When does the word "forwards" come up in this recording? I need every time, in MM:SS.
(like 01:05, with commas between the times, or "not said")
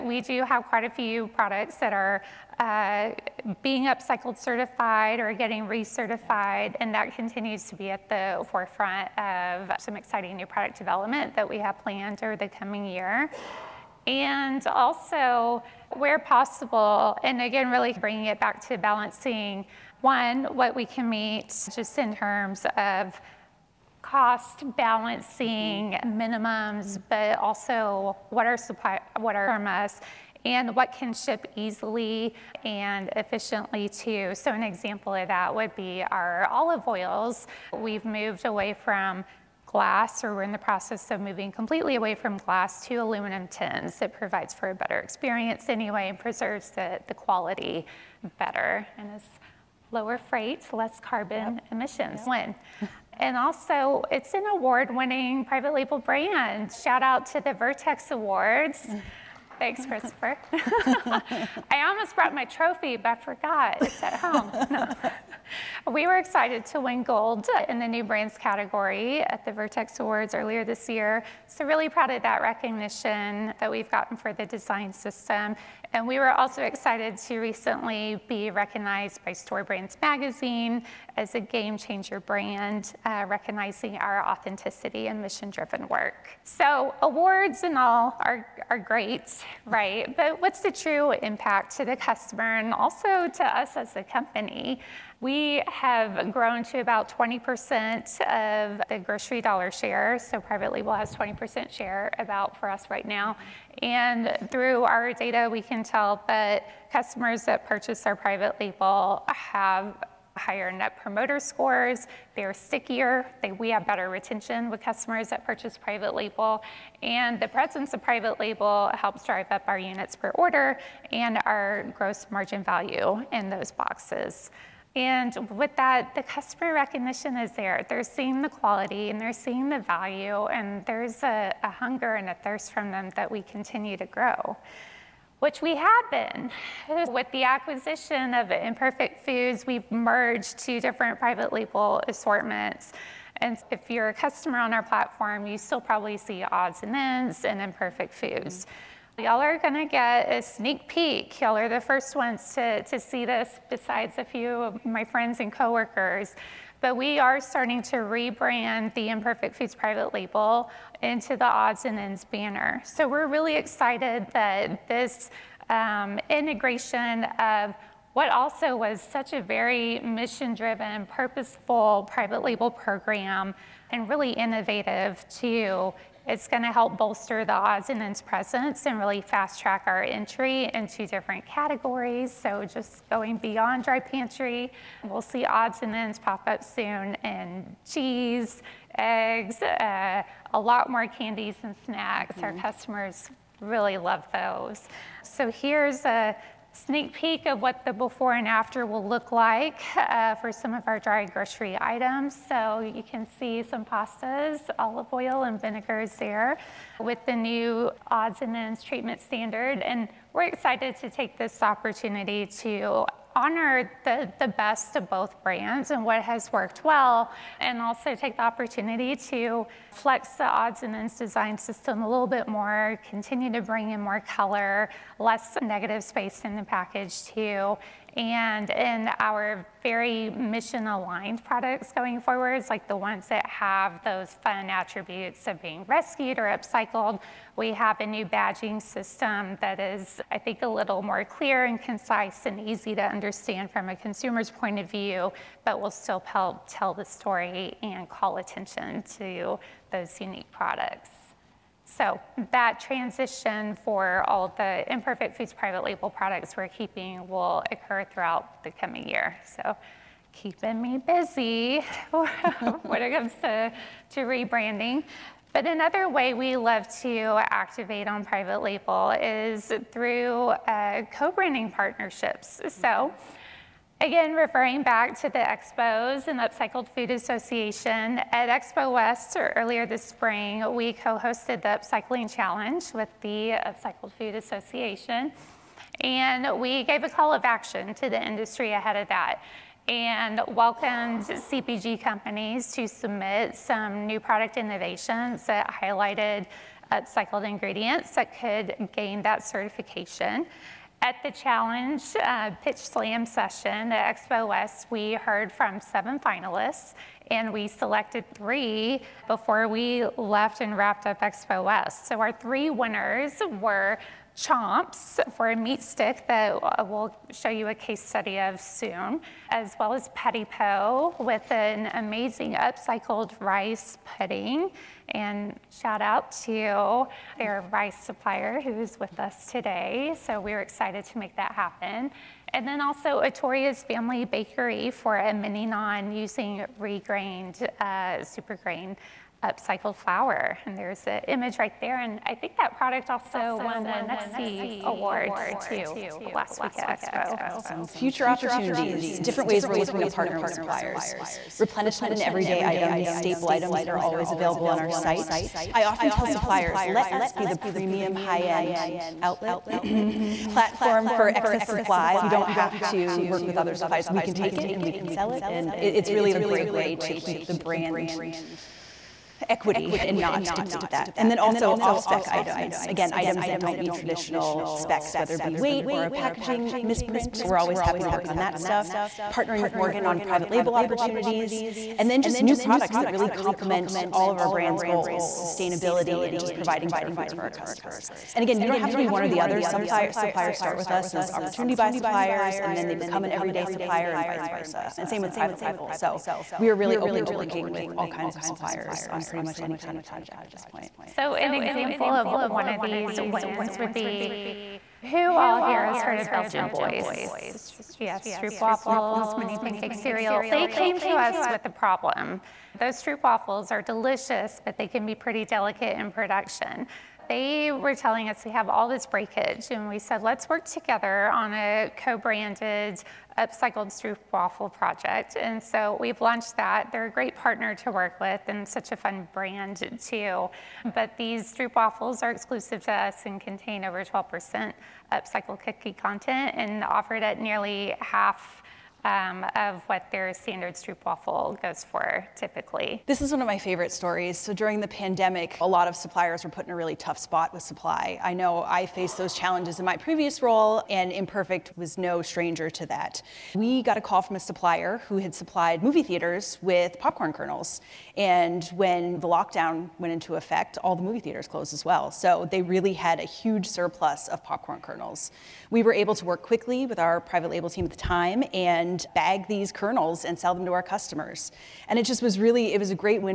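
03:52.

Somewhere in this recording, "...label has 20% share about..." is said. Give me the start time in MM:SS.
01:40.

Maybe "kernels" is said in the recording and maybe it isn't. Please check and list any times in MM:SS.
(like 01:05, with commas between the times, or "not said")
07:37, 07:44, 07:49.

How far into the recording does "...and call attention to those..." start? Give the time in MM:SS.
04:07.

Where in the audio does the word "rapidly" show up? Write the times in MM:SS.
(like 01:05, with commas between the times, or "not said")
not said.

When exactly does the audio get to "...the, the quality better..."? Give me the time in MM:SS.
00:46.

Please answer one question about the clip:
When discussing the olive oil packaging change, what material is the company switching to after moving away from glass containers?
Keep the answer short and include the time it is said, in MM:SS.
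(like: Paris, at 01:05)
aluminum tins, at 00:42.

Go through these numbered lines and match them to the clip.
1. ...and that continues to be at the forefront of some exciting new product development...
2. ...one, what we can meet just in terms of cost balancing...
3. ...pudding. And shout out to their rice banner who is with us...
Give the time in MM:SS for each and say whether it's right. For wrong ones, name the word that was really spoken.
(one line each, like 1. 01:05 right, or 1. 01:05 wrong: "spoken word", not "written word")
1. 00:06 right
2. 00:19 right
3. 05:24 wrong: "supplier", not "banner".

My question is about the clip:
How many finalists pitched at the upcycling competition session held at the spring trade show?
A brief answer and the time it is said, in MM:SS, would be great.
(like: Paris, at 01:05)
7, at 05:05.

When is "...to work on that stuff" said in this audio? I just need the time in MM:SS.
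06:18.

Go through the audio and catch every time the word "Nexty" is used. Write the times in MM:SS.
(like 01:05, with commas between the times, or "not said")
05:44.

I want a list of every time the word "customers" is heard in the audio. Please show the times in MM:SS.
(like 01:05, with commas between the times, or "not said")
01:31, 01:46, 01:54, 02:06, 02:24, 03:12, 06:27, 07:50.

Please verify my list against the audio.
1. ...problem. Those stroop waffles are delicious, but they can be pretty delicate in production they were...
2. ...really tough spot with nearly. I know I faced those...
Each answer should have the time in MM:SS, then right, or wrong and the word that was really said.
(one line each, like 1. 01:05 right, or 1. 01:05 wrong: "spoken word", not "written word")
1. 06:51 right
2. 07:26 wrong: "supply", not "nearly".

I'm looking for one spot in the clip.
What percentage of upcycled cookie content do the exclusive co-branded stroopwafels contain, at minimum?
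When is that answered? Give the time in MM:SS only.
07:14.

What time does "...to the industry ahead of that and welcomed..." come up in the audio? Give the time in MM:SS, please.
04:47.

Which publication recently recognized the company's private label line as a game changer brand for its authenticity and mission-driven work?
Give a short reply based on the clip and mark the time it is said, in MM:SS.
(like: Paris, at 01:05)
Store Brands Magazine, at 01:19.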